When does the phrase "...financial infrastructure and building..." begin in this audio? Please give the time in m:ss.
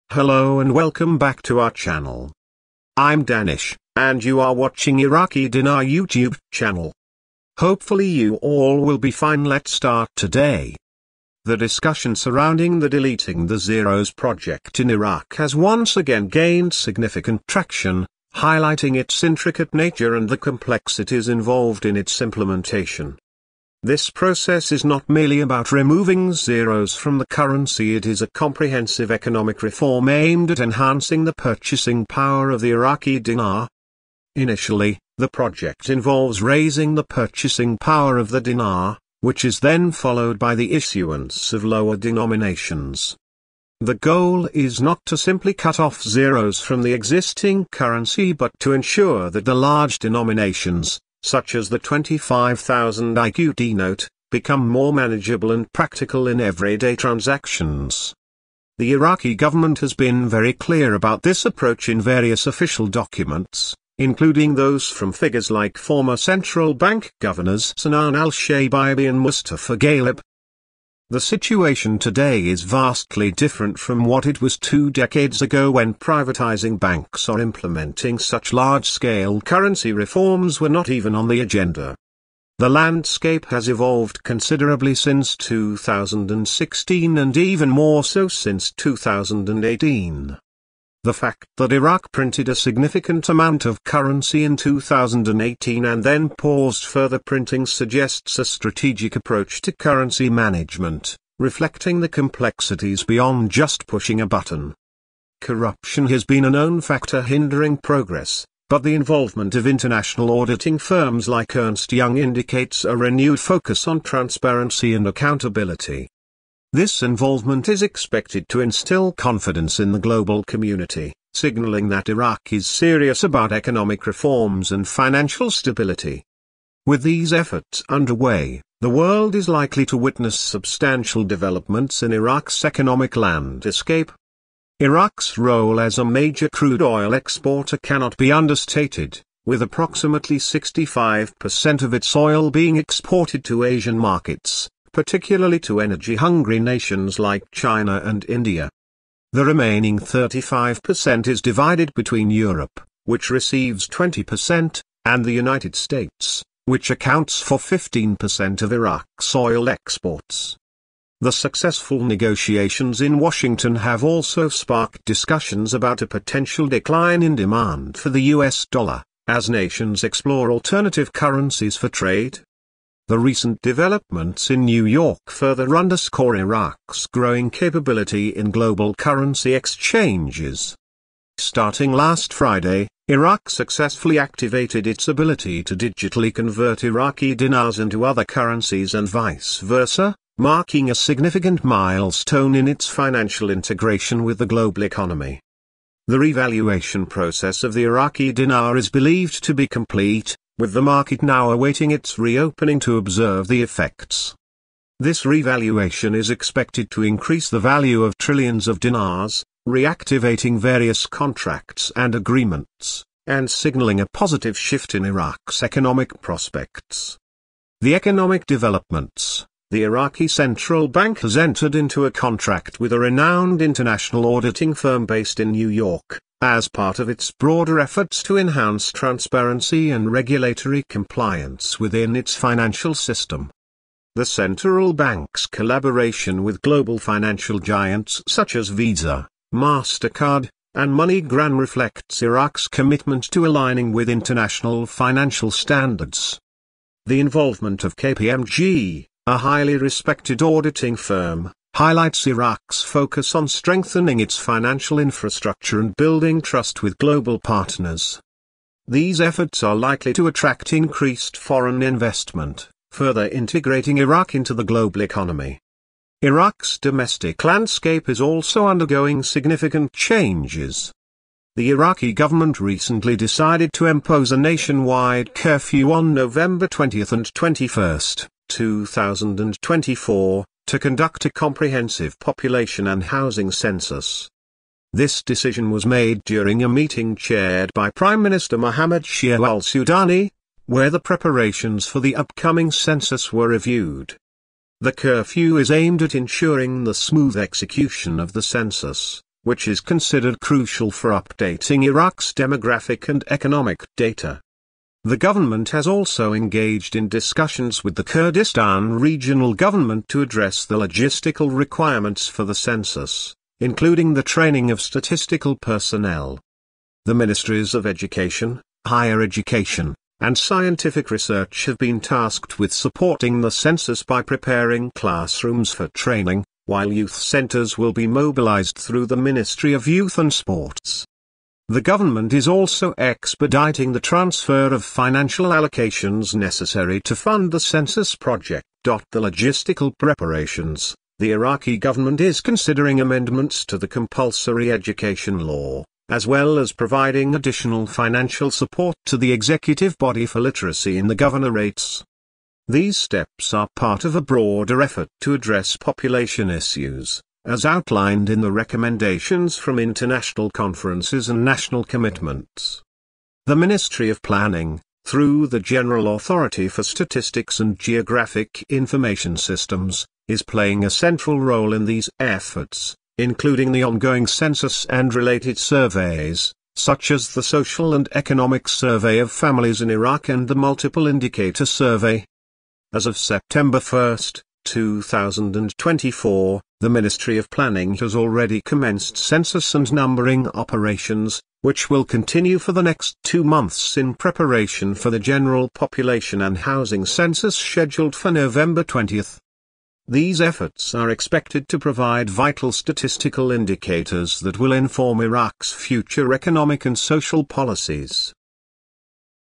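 4:14.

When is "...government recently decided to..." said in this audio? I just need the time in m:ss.
4:32.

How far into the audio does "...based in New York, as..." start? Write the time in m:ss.
3:45.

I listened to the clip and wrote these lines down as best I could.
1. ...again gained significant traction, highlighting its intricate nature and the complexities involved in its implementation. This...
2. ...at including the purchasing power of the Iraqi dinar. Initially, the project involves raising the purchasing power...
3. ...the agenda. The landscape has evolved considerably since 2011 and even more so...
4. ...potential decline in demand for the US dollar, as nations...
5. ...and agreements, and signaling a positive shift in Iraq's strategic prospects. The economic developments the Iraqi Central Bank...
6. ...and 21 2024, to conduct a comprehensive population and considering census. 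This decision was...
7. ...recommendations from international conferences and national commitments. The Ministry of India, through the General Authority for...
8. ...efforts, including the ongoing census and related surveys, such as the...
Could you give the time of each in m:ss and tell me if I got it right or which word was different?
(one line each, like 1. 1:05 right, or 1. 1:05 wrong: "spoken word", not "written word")
1. 0:15 right
2. 0:30 wrong: "enhancing", not "including"
3. 1:21 wrong: "2016", not "2011"
4. 2:46 right
5. 3:31 wrong: "economic", not "strategic"
6. 4:37 wrong: "housing", not "considering"
7. 5:58 wrong: "Planning", not "India"
8. 6:12 right.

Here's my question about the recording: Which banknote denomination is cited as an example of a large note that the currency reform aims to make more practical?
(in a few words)
25,000 IQD.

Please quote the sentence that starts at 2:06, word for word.
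With these efforts underway, the world is likely to witness substantial developments in Iraq's economic landscape.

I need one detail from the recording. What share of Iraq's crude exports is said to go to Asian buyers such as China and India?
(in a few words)
65%.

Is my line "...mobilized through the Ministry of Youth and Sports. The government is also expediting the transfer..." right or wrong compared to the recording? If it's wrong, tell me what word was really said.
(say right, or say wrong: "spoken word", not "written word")
right.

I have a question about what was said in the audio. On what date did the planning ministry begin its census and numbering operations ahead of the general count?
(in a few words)
September 1, 2024.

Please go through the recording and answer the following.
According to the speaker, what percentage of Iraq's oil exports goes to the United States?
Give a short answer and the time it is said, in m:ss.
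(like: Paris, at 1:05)
15%, at 2:37.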